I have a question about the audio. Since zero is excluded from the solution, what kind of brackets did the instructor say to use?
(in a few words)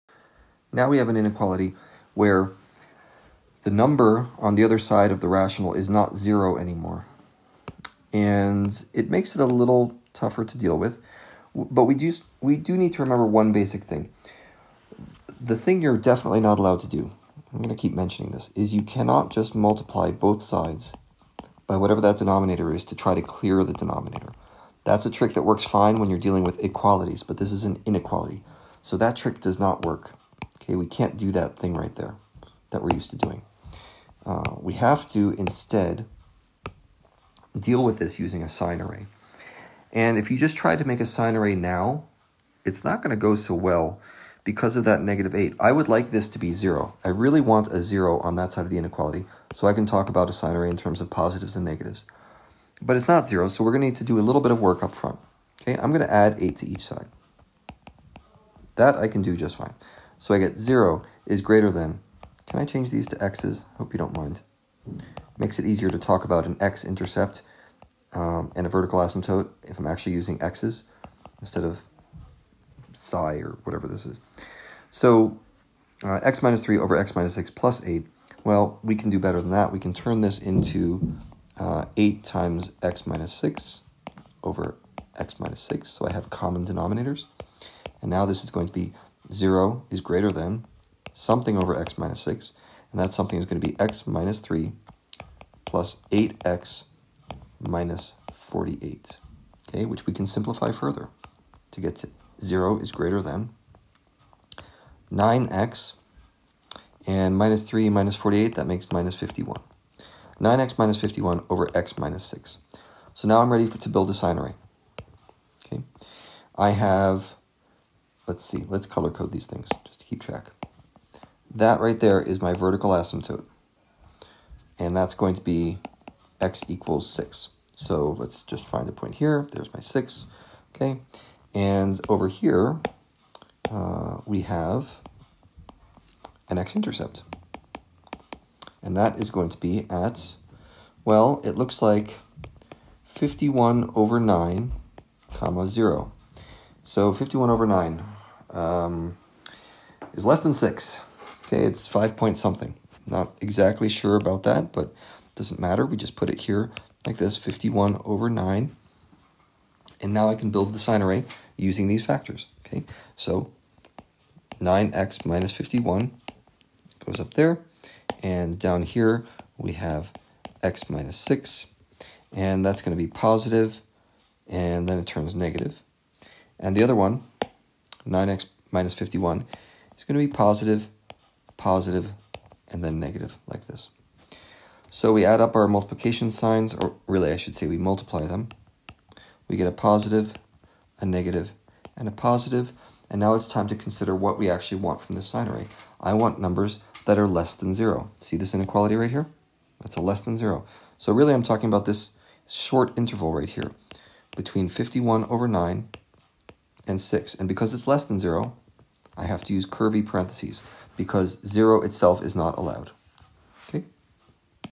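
curvy parentheses.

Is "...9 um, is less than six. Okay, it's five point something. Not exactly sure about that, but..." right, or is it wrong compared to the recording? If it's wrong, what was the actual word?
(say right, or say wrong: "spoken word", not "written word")
right.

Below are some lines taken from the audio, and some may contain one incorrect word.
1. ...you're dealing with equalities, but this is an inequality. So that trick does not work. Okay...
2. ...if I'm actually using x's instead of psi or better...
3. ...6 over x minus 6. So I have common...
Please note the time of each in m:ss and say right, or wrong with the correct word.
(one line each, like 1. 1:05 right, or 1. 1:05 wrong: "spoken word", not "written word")
1. 0:26 right
2. 1:09 wrong: "whatever", not "better"
3. 1:23 right.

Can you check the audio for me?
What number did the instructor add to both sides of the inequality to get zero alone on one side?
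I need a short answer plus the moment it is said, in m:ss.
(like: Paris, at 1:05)
8, at 0:55.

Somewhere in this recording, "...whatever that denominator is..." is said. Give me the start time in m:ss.
0:21.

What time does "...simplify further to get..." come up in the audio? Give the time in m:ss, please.
1:40.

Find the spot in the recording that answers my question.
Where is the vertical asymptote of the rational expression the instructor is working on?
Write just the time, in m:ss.
2:06.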